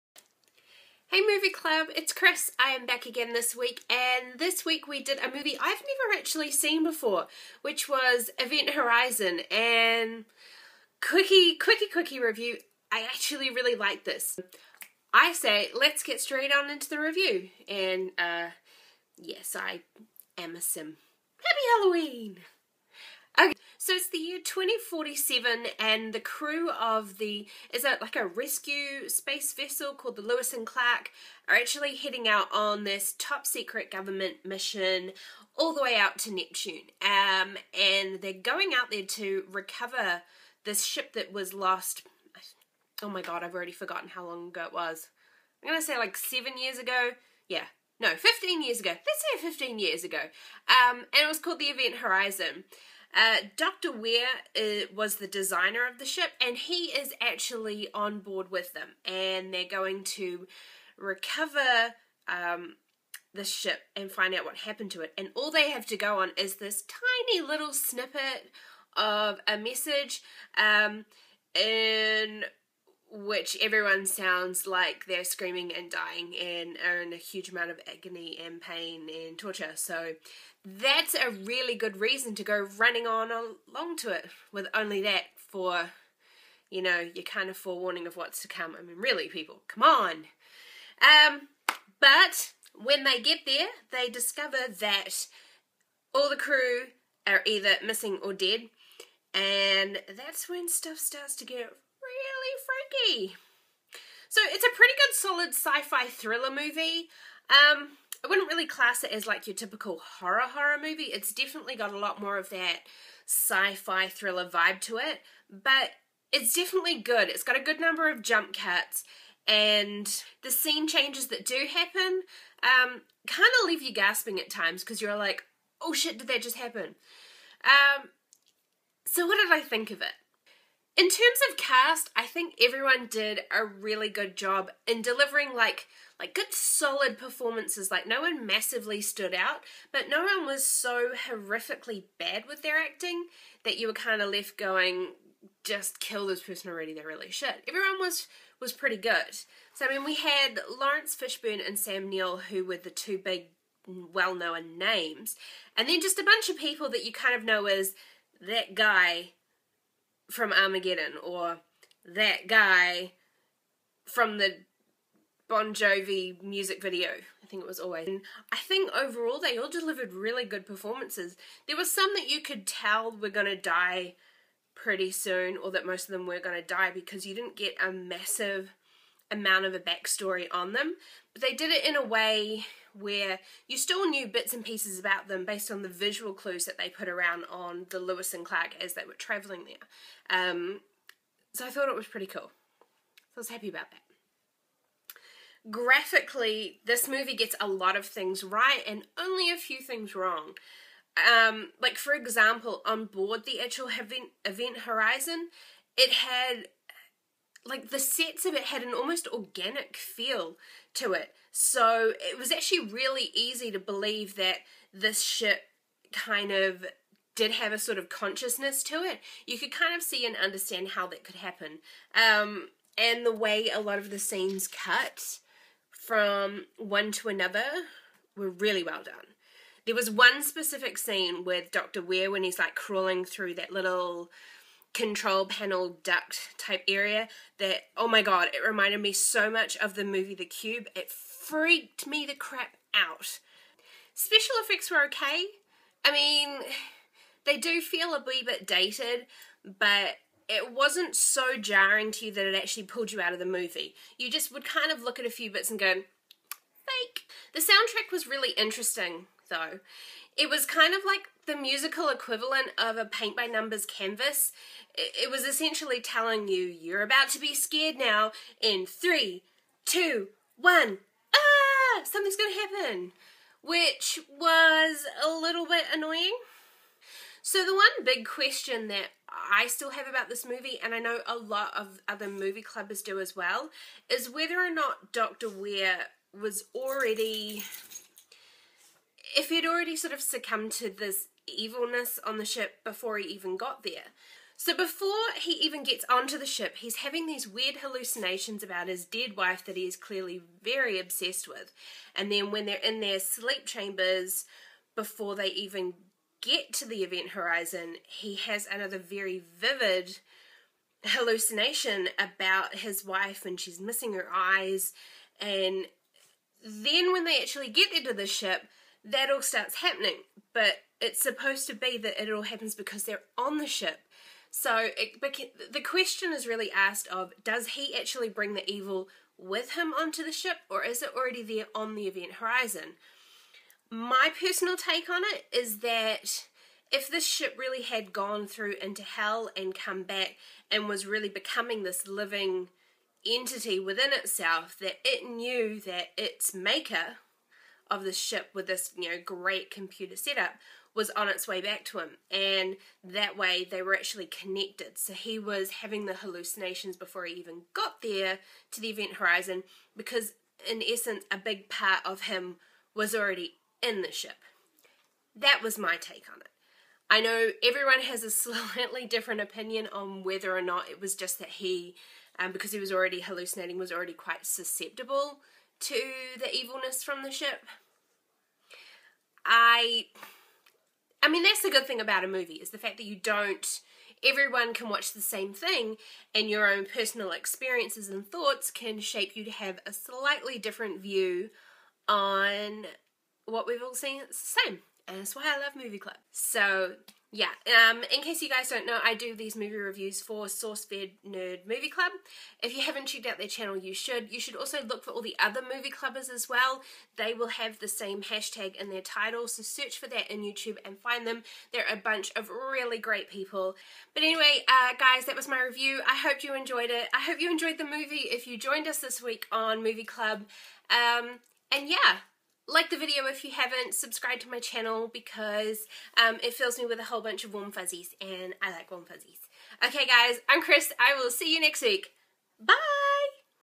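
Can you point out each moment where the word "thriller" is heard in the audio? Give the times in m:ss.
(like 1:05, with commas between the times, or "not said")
1:46, 1:54.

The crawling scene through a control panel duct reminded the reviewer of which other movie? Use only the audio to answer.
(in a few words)
The Cube.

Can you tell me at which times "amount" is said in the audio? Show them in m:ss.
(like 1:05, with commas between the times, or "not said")
1:17, 2:59.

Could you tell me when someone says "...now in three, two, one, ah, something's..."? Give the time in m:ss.
4:27.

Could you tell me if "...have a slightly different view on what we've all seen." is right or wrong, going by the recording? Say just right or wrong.
right.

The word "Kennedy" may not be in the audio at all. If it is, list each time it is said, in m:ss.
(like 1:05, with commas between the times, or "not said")
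not said.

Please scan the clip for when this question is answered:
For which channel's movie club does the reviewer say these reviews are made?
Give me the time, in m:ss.
6:40.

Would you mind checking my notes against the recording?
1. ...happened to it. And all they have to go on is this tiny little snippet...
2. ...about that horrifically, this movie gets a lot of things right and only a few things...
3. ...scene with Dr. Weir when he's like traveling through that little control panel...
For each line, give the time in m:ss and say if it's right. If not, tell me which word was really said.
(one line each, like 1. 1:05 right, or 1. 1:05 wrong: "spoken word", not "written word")
1. 1:04 right
2. 3:13 wrong: "graphically", not "horrifically"
3. 3:50 wrong: "crawling", not "traveling".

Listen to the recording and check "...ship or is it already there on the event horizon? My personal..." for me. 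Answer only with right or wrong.
right.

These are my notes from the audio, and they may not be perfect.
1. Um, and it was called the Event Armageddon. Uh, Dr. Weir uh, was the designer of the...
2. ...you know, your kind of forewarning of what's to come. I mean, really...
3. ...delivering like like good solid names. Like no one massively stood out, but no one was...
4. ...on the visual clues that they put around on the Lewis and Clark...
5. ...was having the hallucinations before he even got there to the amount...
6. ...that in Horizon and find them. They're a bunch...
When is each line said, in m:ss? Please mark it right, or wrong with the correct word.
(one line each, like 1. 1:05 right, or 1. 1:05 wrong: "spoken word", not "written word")
1. 0:50 wrong: "Horizon", not "Armageddon"
2. 1:26 right
3. 2:15 wrong: "performances", not "names"
4. 3:05 right
5. 5:55 wrong: "event", not "amount"
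6. 6:50 wrong: "YouTube", not "Horizon".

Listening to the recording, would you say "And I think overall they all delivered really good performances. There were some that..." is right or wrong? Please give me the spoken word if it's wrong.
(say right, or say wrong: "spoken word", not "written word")
right.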